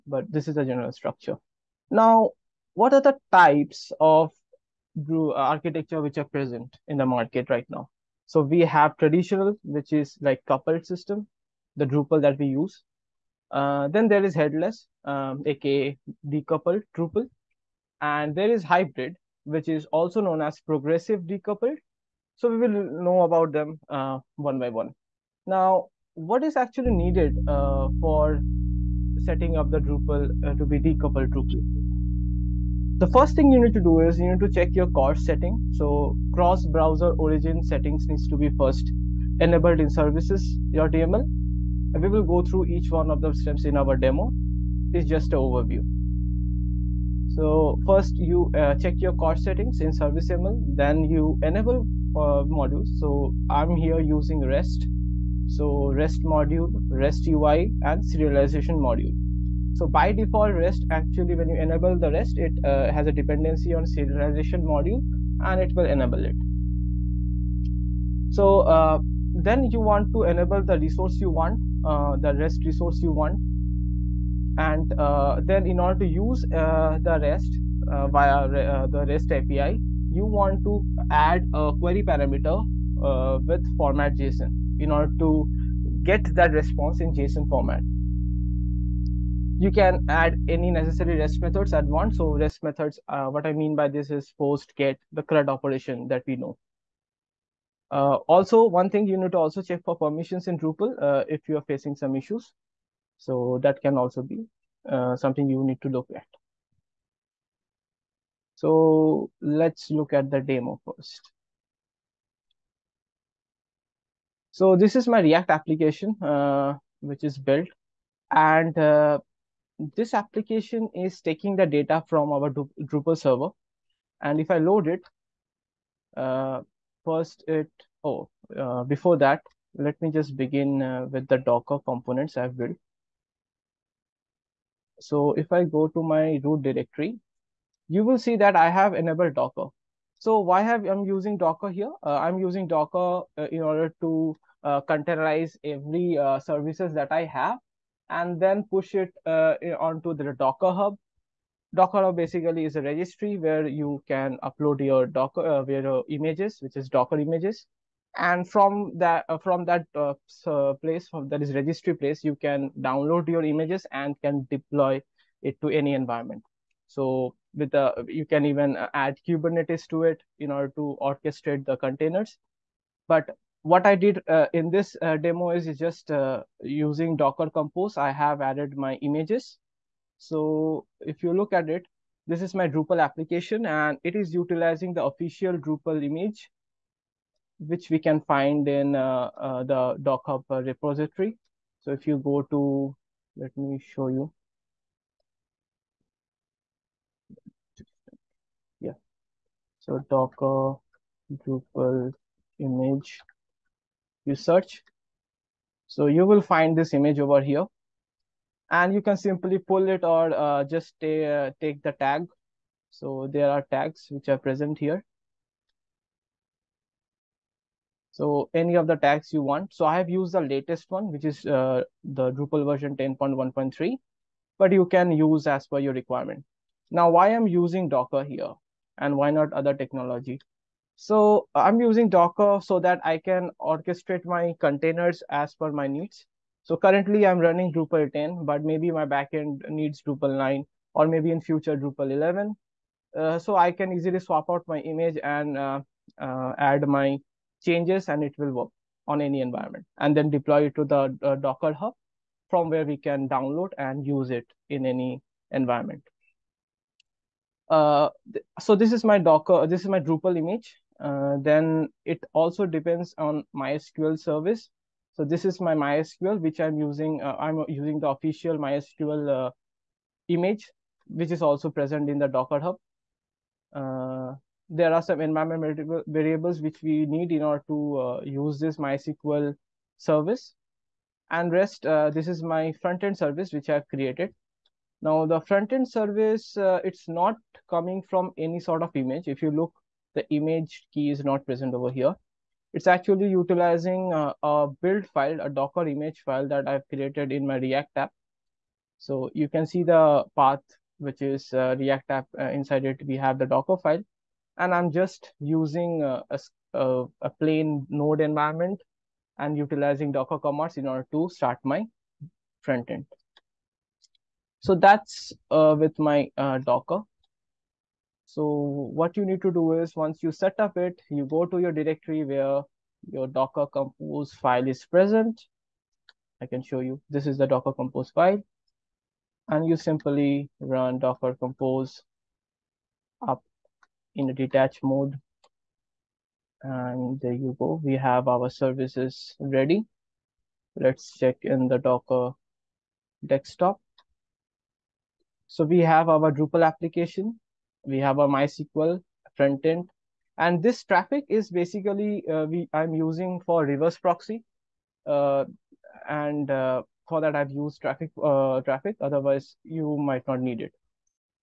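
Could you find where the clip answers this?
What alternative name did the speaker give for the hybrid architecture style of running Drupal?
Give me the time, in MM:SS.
00:20.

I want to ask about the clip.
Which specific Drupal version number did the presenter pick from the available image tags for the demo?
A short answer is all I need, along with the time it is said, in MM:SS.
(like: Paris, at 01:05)
10.1.3, at 03:42.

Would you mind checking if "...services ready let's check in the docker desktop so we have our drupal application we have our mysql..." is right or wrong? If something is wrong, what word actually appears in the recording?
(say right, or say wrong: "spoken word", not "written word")
right.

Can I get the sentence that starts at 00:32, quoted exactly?
The first thing you need to do is you need to check your CORS setting.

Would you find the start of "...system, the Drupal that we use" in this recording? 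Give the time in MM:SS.
00:10.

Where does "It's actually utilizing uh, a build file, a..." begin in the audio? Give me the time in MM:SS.
04:52.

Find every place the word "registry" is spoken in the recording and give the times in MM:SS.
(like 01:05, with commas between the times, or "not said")
02:32, 02:41.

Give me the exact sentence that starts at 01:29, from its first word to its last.
You can add any necessary REST methods at once.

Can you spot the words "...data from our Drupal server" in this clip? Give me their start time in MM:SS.
02:01.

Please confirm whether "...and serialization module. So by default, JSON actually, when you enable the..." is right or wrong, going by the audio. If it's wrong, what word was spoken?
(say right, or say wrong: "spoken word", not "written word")
wrong: "REST", not "JSON".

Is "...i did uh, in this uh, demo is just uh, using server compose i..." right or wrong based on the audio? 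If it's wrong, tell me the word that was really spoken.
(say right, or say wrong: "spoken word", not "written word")
wrong: "docker", not "server".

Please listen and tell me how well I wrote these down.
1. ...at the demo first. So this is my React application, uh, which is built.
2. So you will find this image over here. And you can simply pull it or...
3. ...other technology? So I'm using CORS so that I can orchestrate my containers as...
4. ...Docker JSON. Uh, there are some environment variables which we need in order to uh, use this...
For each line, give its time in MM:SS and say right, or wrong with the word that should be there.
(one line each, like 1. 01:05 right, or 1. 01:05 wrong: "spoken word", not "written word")
1. 01:50 right
2. 03:25 right
3. 03:49 wrong: "Docker", not "CORS"
4. 04:32 wrong: "Hub", not "JSON".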